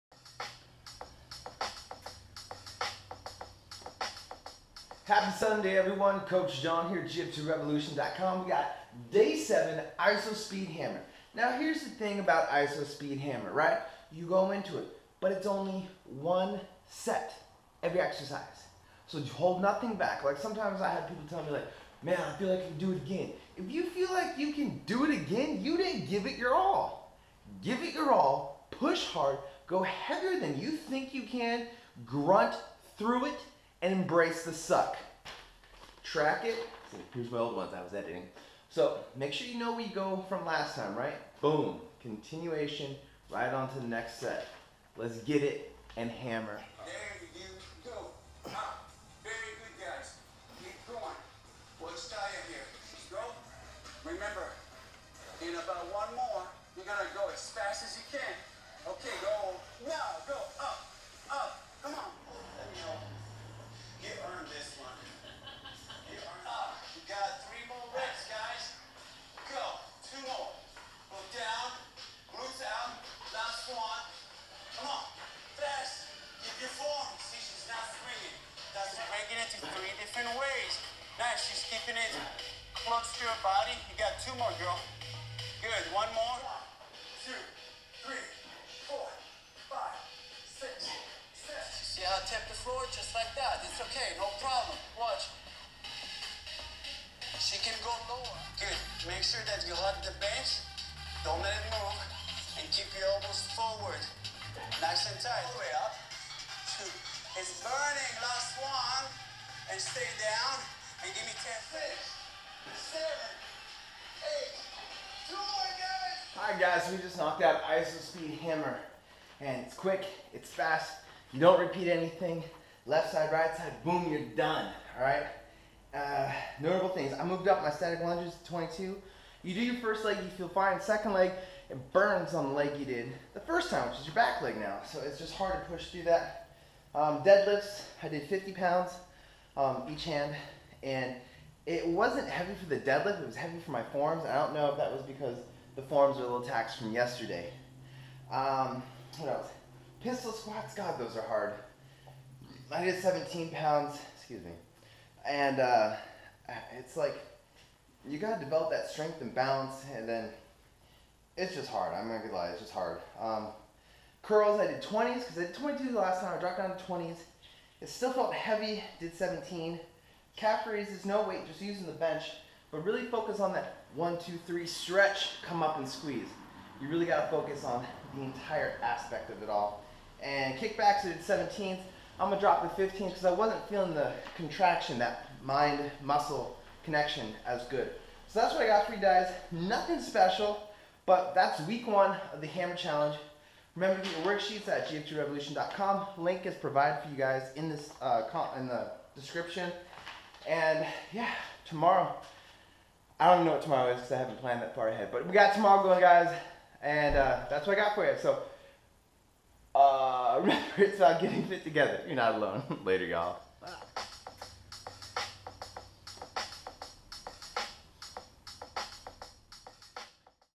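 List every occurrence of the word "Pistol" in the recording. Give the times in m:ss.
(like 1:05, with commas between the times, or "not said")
2:30.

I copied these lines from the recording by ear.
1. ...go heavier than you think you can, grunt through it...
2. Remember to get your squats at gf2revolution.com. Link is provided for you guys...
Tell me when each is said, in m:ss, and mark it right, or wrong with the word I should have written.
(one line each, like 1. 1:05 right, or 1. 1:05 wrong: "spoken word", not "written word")
1. 0:29 right
2. 3:13 wrong: "worksheets", not "squats".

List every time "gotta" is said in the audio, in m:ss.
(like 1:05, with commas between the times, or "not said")
2:38, 2:57.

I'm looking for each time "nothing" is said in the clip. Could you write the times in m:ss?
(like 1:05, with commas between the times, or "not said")
0:19, 3:09.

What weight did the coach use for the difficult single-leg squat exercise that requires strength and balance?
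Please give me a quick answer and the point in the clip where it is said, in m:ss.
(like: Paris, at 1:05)
17 pounds, at 2:33.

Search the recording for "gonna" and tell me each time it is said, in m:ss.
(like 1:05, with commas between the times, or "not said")
0:56, 2:42, 3:02.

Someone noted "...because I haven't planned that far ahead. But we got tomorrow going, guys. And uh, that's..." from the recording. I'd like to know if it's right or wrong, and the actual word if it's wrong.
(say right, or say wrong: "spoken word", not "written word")
right.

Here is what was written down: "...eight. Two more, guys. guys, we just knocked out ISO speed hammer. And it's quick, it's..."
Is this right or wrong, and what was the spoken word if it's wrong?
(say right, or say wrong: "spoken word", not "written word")
right.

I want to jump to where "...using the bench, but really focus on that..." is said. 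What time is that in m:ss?
2:51.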